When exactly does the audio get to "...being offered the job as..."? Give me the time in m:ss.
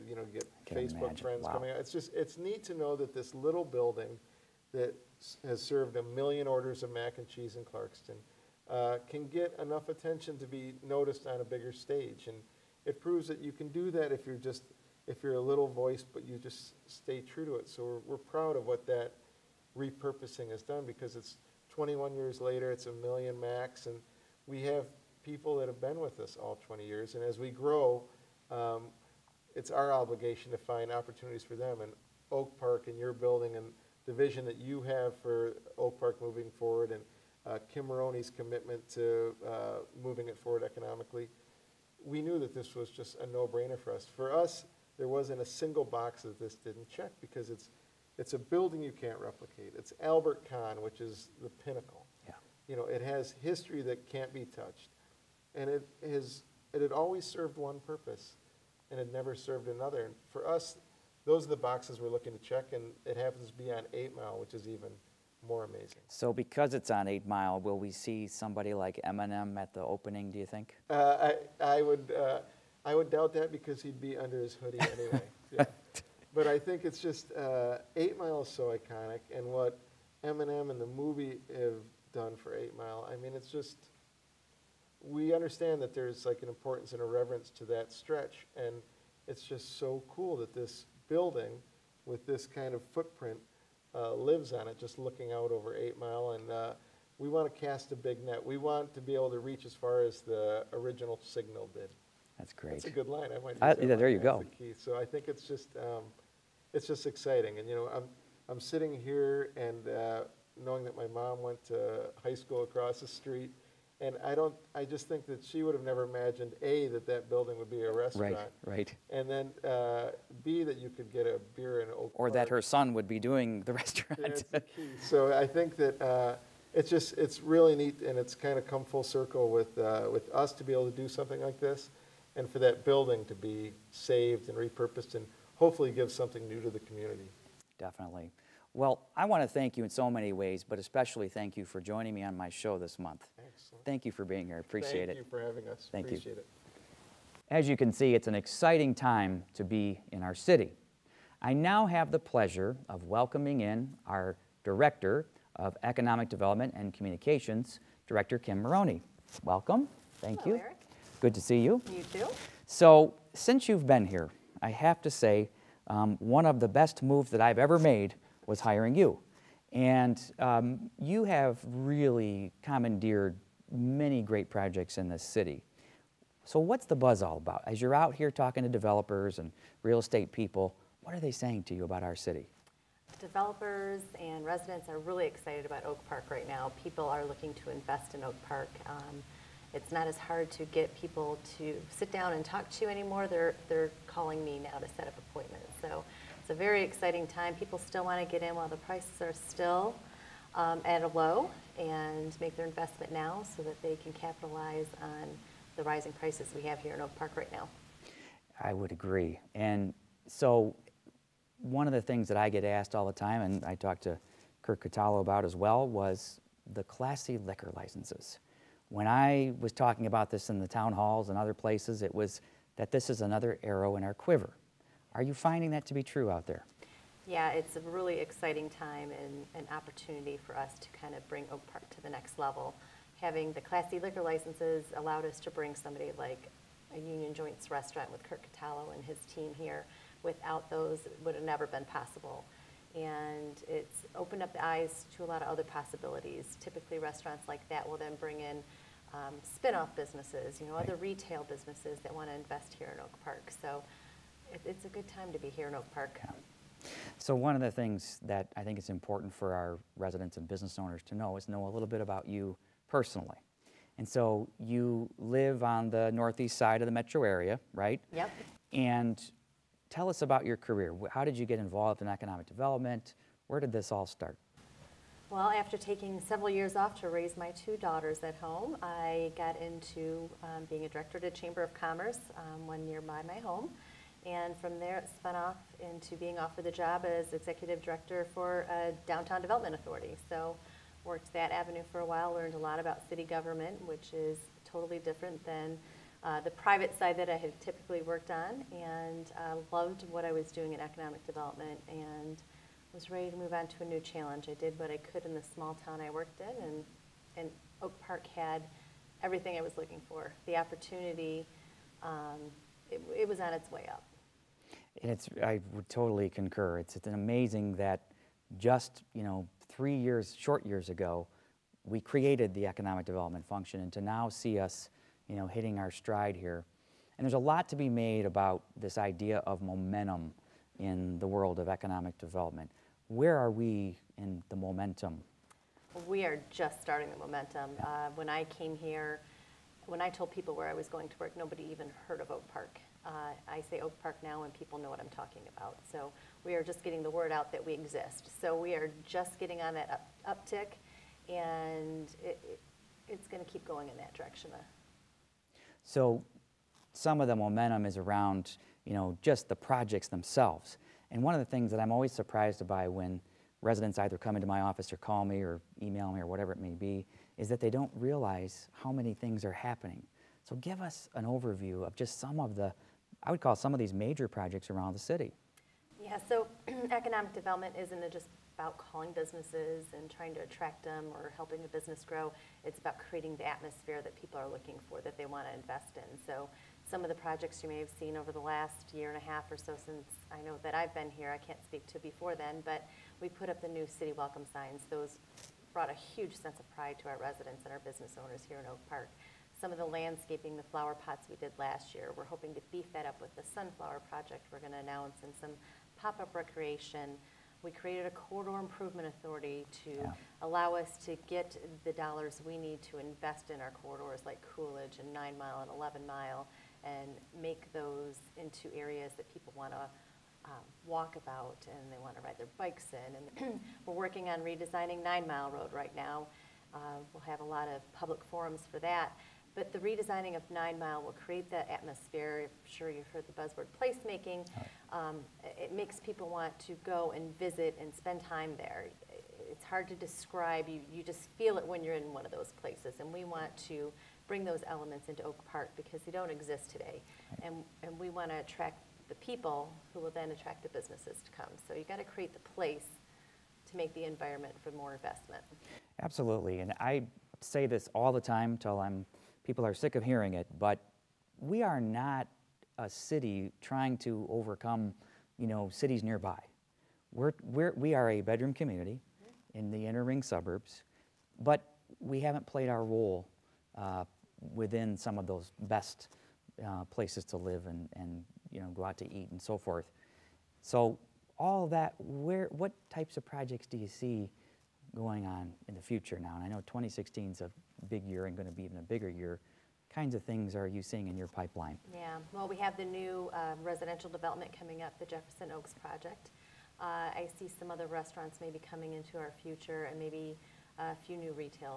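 4:46.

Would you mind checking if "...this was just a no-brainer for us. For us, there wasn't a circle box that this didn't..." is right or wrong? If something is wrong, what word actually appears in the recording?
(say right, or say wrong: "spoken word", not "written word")
wrong: "single", not "circle".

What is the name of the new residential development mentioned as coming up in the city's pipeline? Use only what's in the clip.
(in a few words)
Jefferson Oaks.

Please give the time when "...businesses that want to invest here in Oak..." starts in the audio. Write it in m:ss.
4:11.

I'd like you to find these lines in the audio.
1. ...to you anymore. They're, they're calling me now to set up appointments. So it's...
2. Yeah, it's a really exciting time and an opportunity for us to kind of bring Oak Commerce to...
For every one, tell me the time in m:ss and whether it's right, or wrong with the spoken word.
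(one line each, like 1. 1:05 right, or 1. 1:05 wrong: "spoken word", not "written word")
1. 3:12 right
2. 3:47 wrong: "Park", not "Commerce".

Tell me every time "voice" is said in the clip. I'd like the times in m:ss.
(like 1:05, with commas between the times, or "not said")
0:15.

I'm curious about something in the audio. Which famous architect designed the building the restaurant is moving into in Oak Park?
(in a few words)
Albert Kahn.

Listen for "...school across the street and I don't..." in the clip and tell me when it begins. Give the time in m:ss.
1:52.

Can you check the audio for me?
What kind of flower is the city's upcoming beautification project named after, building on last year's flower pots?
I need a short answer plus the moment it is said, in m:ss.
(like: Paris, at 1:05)
Sunflower, at 6:43.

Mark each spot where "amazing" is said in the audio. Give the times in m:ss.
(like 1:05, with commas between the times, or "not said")
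1:05, 5:17.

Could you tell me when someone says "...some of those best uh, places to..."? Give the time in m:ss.
7:54.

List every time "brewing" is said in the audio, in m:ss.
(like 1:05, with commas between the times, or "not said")
not said.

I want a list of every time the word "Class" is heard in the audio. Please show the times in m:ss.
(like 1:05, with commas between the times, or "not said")
3:36, 3:53.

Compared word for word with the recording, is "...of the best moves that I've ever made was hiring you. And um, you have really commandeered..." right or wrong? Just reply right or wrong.
right.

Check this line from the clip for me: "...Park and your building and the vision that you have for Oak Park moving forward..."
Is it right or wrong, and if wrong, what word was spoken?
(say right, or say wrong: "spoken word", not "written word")
right.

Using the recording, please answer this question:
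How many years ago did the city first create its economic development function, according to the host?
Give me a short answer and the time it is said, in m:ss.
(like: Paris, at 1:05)
3, at 5:19.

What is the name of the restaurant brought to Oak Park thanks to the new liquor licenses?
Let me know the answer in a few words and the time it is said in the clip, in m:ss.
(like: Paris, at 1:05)
Union Joints, at 3:56.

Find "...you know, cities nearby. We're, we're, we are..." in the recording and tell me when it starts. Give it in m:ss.
7:45.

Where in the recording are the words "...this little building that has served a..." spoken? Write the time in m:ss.
0:03.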